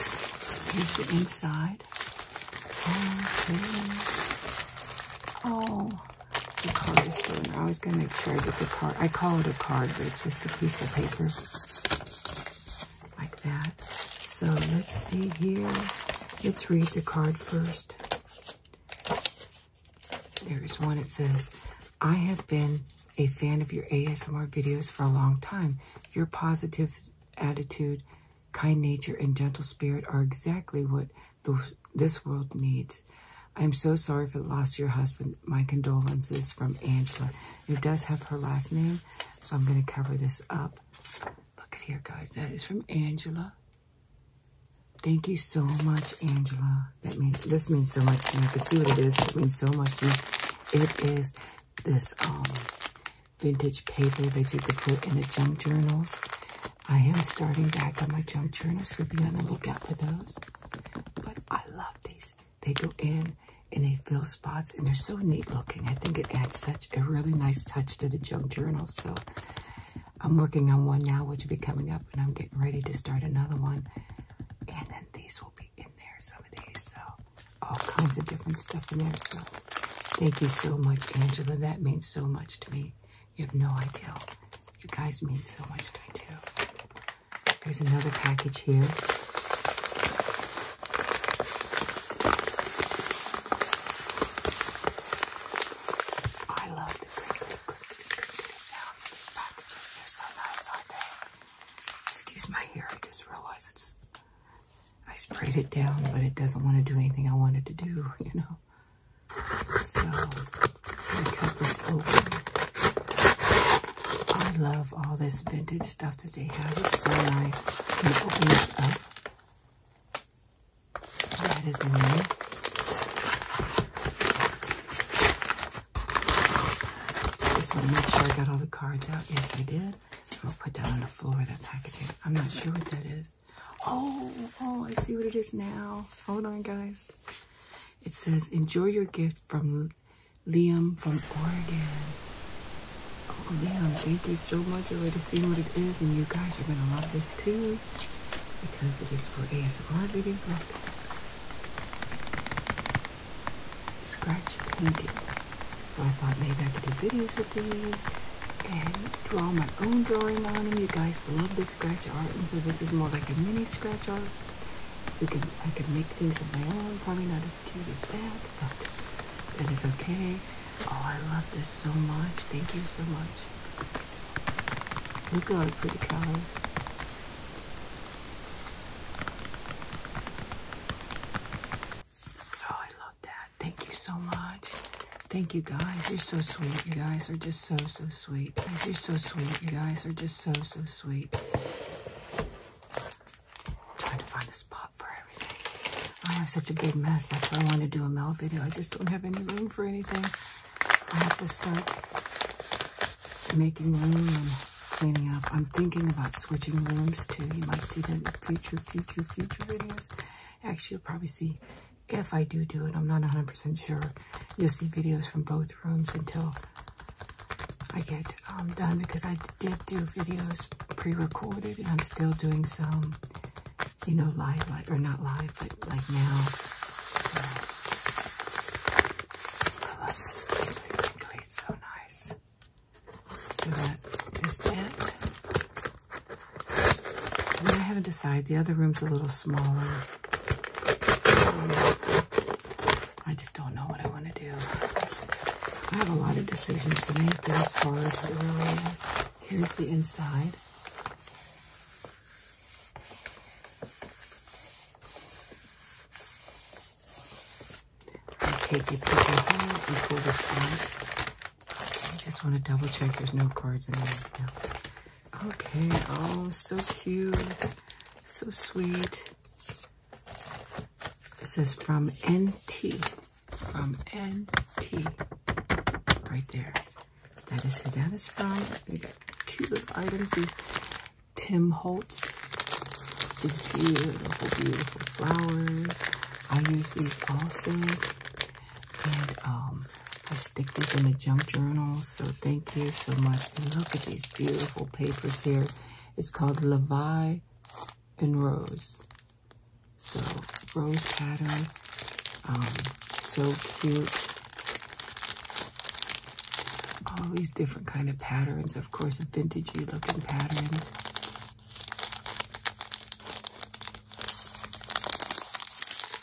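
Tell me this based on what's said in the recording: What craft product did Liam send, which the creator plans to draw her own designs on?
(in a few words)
Scratch painting.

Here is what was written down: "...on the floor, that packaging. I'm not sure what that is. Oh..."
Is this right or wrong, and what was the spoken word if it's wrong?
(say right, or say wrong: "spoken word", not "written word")
right.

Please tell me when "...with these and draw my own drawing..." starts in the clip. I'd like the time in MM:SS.
02:37.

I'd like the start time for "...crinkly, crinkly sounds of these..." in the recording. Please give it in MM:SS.
01:37.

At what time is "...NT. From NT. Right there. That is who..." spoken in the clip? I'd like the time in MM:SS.
04:32.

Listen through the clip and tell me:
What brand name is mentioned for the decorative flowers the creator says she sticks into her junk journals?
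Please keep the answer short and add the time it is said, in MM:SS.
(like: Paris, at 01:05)
Tim Holtz, at 04:41.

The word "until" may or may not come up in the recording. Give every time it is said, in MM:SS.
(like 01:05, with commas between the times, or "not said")
03:36.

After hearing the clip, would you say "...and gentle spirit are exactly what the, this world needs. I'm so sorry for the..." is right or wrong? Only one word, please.
right.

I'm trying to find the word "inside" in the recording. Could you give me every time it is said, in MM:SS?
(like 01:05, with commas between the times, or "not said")
00:01, 04:09.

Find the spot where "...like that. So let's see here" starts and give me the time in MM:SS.
00:13.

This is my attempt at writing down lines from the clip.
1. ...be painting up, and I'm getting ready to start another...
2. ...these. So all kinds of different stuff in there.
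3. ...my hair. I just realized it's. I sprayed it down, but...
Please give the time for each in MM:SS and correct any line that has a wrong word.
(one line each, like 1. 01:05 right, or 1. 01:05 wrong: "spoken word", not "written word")
1. 01:11 wrong: "coming", not "painting"
2. 01:16 right
3. 01:42 right.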